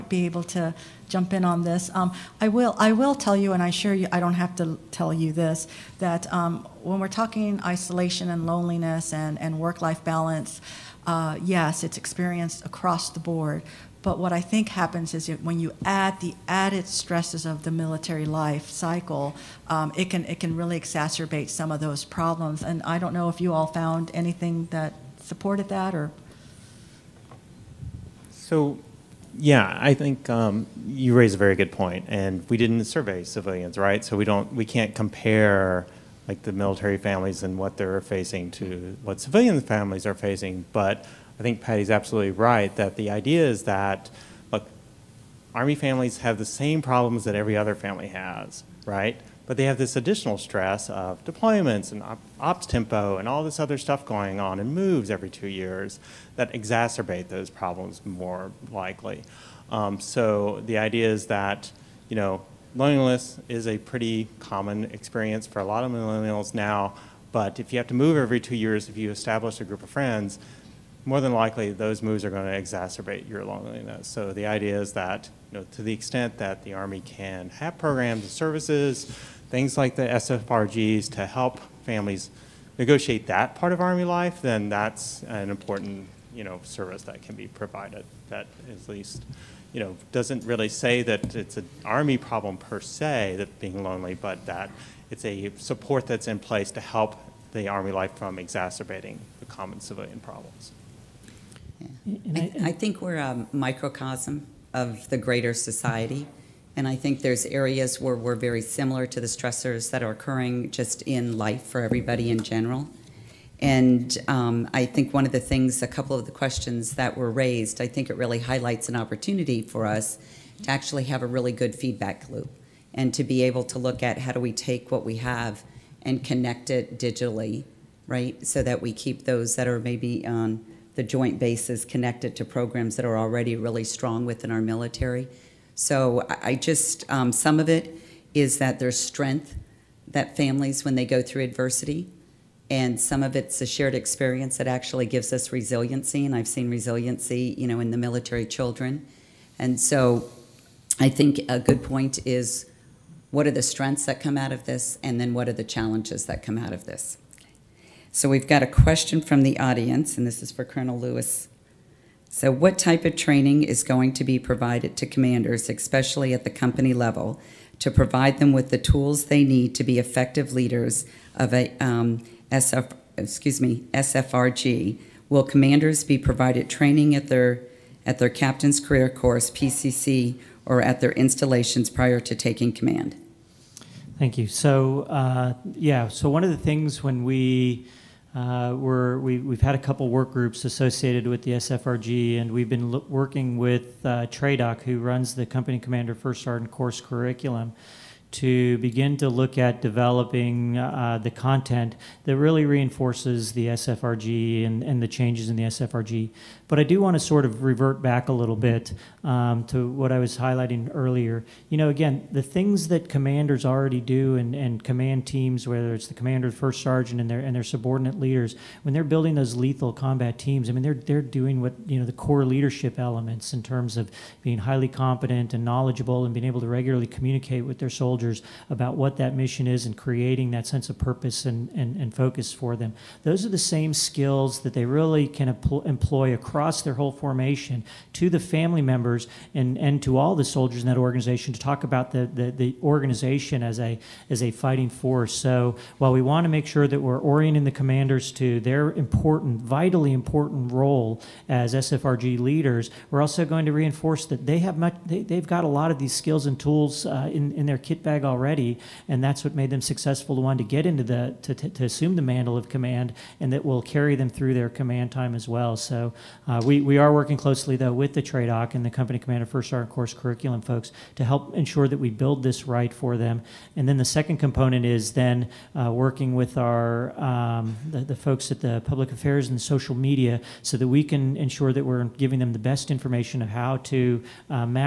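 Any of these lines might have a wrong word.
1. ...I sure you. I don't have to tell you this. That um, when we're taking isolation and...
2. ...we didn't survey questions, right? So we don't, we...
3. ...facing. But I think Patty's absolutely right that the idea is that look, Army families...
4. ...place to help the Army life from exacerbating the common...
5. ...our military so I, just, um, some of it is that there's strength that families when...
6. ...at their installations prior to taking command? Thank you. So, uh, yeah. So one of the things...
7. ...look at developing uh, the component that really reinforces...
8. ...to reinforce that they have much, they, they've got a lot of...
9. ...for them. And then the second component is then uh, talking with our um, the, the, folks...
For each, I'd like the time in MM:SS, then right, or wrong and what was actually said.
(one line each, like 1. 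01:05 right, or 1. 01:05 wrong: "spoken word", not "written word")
1. 00:03 wrong: "talking", not "taking"
2. 00:32 wrong: "civilians", not "questions"
3. 00:40 right
4. 01:36 right
5. 02:14 right
6. 03:00 right
7. 03:19 wrong: "content", not "component"
8. 04:13 right
9. 04:32 wrong: "working", not "talking".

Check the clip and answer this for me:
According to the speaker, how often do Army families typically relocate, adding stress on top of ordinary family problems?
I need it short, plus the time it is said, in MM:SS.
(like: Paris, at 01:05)
Every 2 years, at 00:54.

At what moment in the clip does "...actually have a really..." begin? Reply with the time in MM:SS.
02:00.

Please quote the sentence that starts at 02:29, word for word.
And so I think a good point is what are the strengths that come out of this?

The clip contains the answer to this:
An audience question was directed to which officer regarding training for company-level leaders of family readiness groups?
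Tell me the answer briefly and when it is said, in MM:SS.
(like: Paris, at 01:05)
Colonel Lewis, at 02:40.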